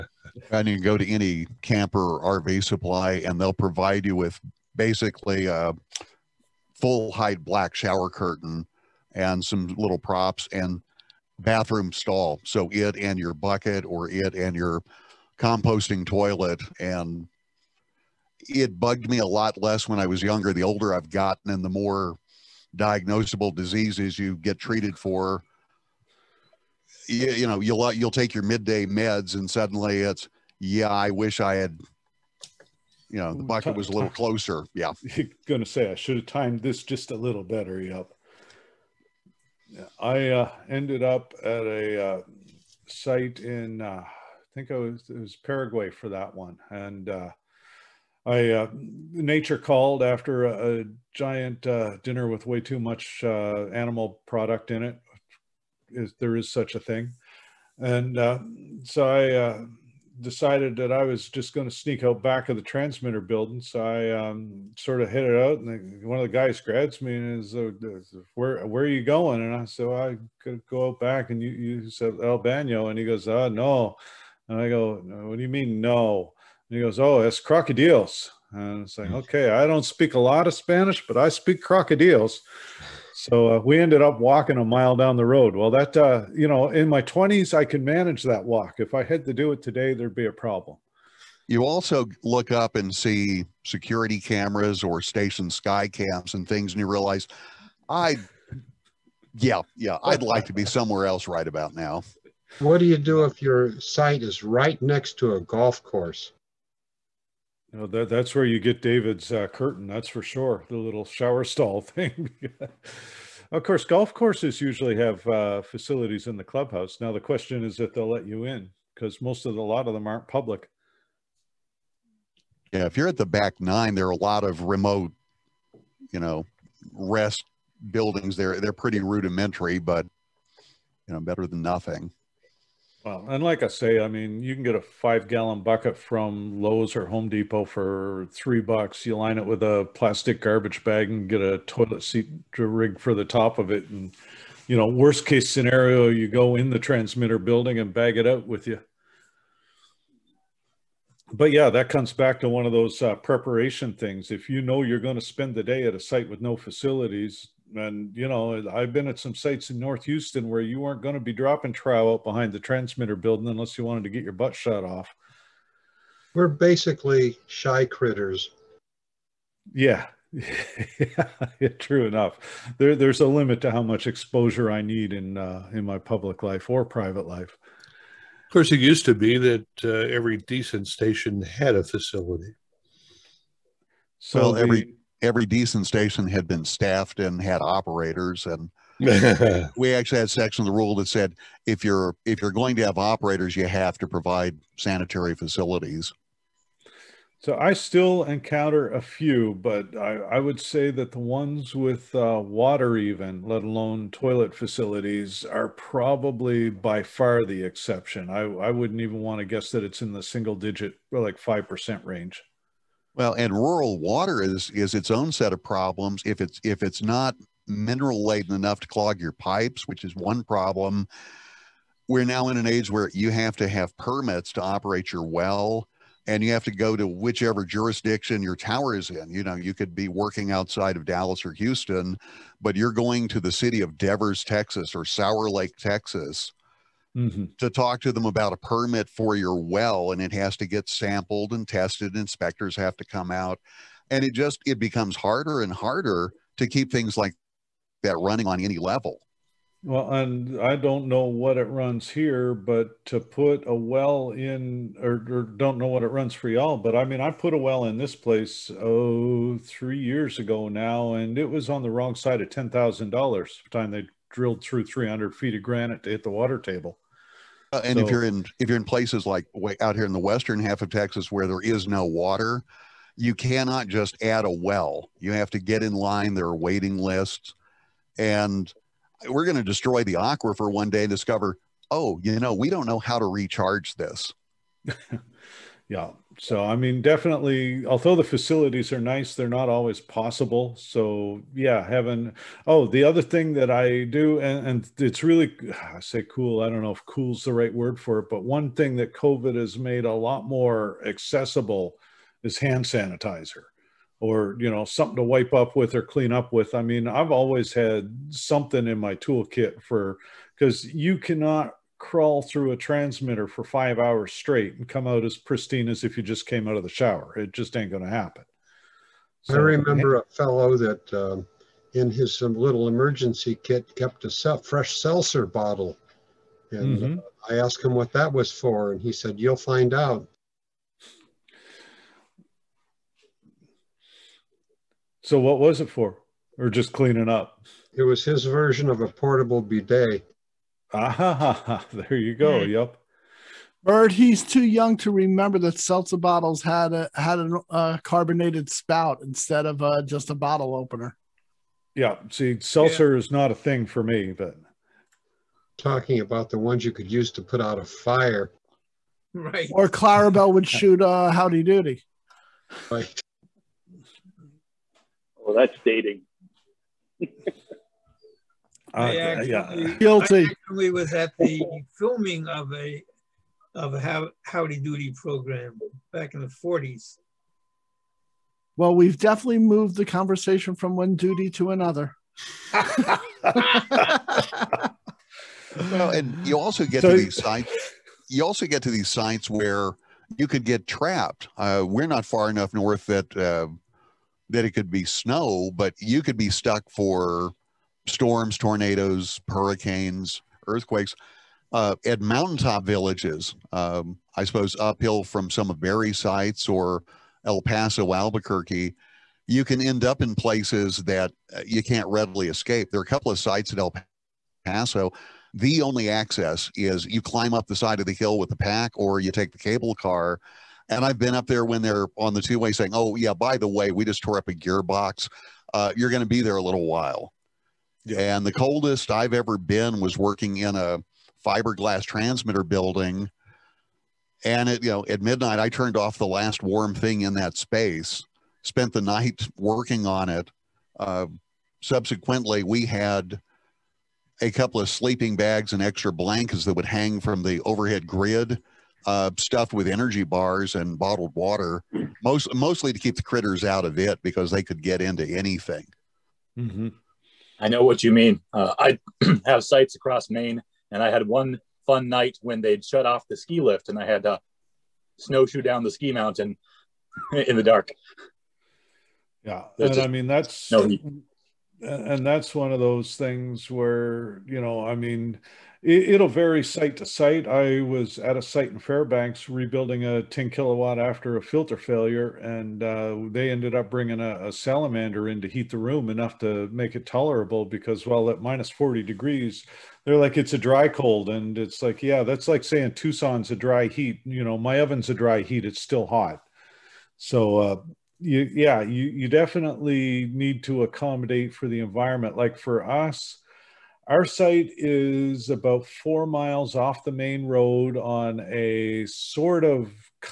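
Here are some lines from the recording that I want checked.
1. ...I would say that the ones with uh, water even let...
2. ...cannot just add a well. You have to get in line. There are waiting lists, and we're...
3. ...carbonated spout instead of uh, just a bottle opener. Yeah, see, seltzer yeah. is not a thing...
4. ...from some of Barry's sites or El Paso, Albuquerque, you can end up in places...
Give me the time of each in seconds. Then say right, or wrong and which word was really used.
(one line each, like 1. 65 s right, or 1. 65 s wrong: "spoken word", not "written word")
1. 200 s right
2. 273 s right
3. 348 s right
4. 405 s right.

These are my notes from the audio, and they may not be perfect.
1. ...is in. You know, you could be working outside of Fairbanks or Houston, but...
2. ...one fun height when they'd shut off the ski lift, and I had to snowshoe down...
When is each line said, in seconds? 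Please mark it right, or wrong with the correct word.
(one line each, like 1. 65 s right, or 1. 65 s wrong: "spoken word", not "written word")
1. 228 s wrong: "Dallas", not "Fairbanks"
2. 461 s wrong: "night", not "height".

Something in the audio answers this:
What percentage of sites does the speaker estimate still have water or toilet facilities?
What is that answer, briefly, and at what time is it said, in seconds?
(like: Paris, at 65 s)
5%, at 211 s.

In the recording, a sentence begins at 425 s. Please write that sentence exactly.
Uh, you're going to be there a little while.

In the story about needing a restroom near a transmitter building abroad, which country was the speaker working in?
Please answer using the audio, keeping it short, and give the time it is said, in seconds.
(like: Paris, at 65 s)
Paraguay, at 45 s.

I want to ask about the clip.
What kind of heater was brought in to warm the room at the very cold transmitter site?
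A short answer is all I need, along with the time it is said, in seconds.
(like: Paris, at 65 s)
Salamander, at 484 s.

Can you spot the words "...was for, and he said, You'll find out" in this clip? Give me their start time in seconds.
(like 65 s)
328 s.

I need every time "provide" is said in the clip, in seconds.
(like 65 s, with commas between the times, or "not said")
3 s, 194 s.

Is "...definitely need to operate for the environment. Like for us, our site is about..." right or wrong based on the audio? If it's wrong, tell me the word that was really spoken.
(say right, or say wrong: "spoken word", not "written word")
wrong: "accommodate", not "operate".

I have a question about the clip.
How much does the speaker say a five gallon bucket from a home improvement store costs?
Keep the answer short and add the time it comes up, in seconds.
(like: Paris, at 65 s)
3 dollars, at 138 s.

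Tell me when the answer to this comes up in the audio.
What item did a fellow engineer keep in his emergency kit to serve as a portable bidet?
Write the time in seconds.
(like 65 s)
324 s.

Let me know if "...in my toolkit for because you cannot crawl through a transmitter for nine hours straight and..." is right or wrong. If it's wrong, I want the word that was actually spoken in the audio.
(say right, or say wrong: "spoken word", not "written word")
wrong: "five", not "nine".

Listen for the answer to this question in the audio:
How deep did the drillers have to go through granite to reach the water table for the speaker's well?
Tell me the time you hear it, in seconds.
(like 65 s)
264 s.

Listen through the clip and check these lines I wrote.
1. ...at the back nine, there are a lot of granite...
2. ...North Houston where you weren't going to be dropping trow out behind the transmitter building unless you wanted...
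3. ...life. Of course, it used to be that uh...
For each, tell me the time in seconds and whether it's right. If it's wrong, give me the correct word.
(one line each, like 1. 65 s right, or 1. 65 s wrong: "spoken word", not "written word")
1. 123 s wrong: "remote", not "granite"
2. 159 s right
3. 177 s right.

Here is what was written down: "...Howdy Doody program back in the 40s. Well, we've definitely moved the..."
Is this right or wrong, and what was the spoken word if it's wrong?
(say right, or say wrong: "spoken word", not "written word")
right.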